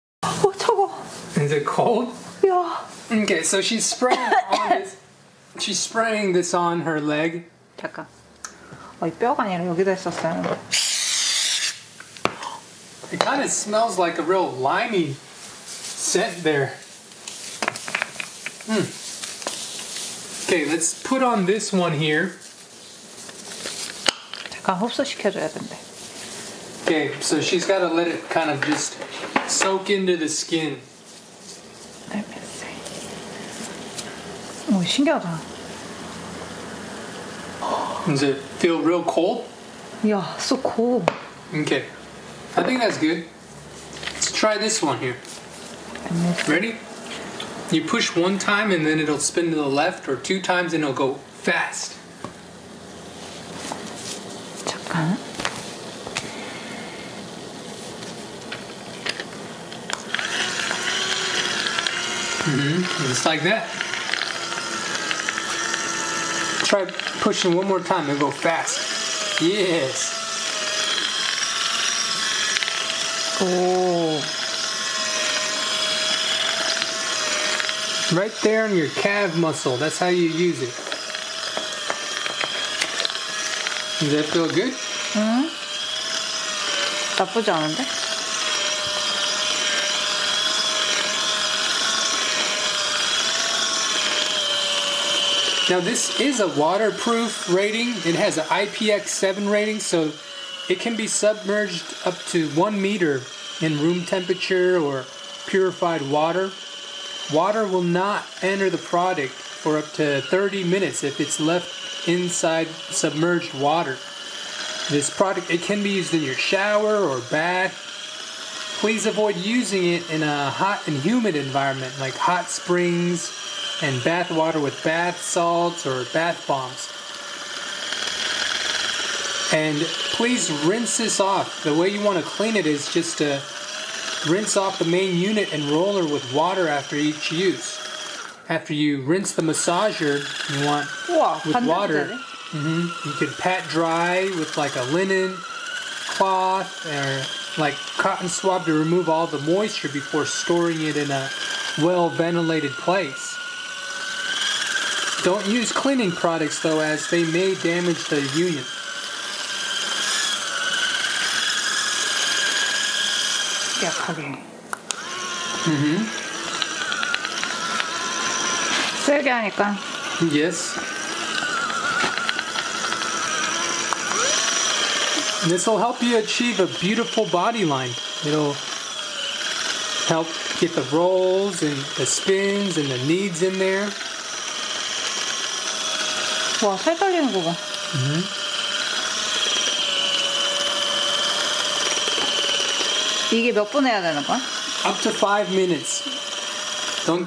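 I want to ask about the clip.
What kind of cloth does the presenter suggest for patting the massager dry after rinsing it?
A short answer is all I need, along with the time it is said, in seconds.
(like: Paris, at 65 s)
linen cloth, at 144 s.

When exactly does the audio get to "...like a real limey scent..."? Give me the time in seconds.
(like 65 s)
13 s.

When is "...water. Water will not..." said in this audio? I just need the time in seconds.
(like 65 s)
106 s.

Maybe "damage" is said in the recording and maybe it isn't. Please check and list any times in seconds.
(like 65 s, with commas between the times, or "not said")
157 s.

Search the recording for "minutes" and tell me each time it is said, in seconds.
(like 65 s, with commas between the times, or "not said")
110 s, 195 s.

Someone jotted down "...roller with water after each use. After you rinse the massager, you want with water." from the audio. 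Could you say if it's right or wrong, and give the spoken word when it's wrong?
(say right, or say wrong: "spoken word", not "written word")
right.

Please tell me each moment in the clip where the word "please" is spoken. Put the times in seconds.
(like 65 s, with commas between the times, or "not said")
118 s, 130 s.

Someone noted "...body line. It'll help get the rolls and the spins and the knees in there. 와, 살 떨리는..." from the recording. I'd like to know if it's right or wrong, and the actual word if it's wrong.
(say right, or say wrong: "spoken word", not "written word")
right.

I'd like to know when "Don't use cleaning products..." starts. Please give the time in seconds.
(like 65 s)
155 s.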